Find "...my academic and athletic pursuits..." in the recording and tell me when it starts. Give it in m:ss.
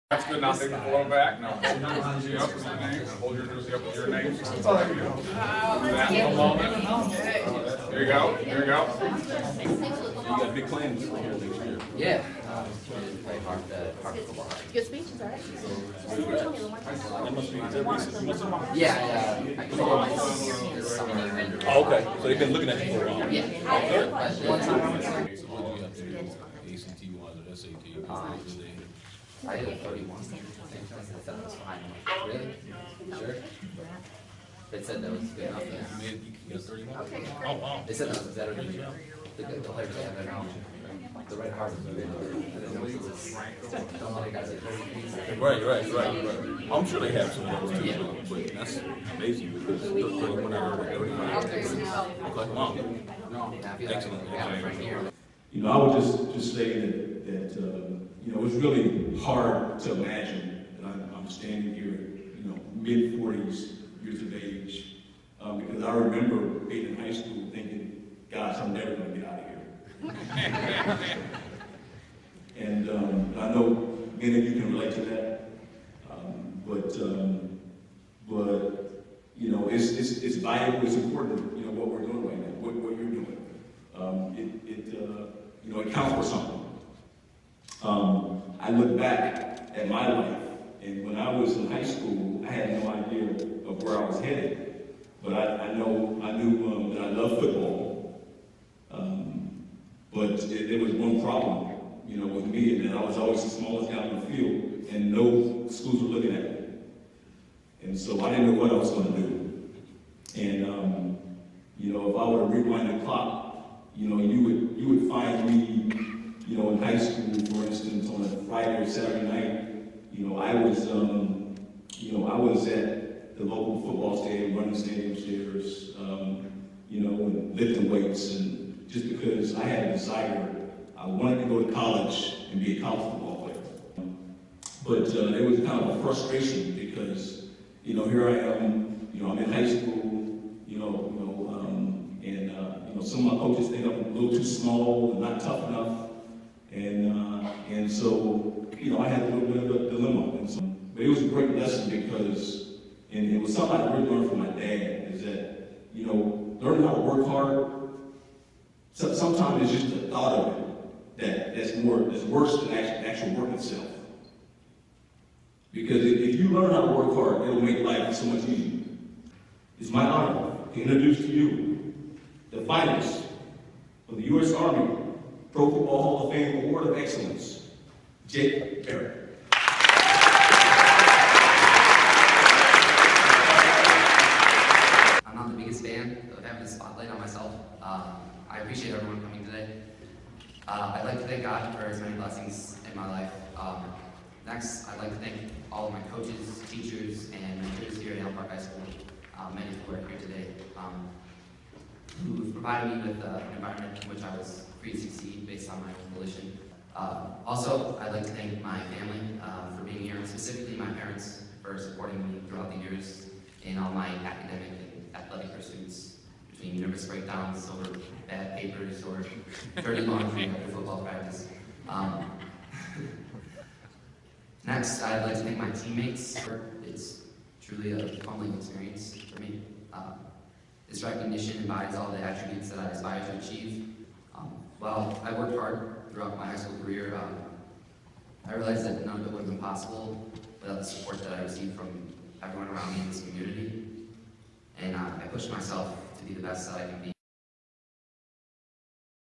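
3:33.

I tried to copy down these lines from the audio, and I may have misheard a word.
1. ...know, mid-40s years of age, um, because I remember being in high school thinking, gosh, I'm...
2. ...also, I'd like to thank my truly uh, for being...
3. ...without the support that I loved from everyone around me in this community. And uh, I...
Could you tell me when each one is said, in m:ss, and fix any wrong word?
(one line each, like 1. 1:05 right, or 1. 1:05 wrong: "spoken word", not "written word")
1. 1:02 right
2. 3:27 wrong: "family", not "truly"
3. 4:00 wrong: "received", not "loved".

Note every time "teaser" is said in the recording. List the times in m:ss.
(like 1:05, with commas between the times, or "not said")
not said.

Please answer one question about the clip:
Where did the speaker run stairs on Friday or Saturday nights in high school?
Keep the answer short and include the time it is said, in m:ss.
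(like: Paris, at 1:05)
local football stadium, at 2:03.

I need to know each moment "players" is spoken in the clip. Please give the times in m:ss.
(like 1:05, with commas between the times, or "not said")
0:39, 2:13.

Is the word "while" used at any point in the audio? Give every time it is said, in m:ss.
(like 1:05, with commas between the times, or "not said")
0:23, 3:54.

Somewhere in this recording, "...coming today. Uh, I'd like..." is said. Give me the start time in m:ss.
3:09.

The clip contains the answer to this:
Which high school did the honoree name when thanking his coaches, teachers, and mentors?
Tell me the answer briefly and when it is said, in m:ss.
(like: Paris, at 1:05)
Allen Park High School, at 3:18.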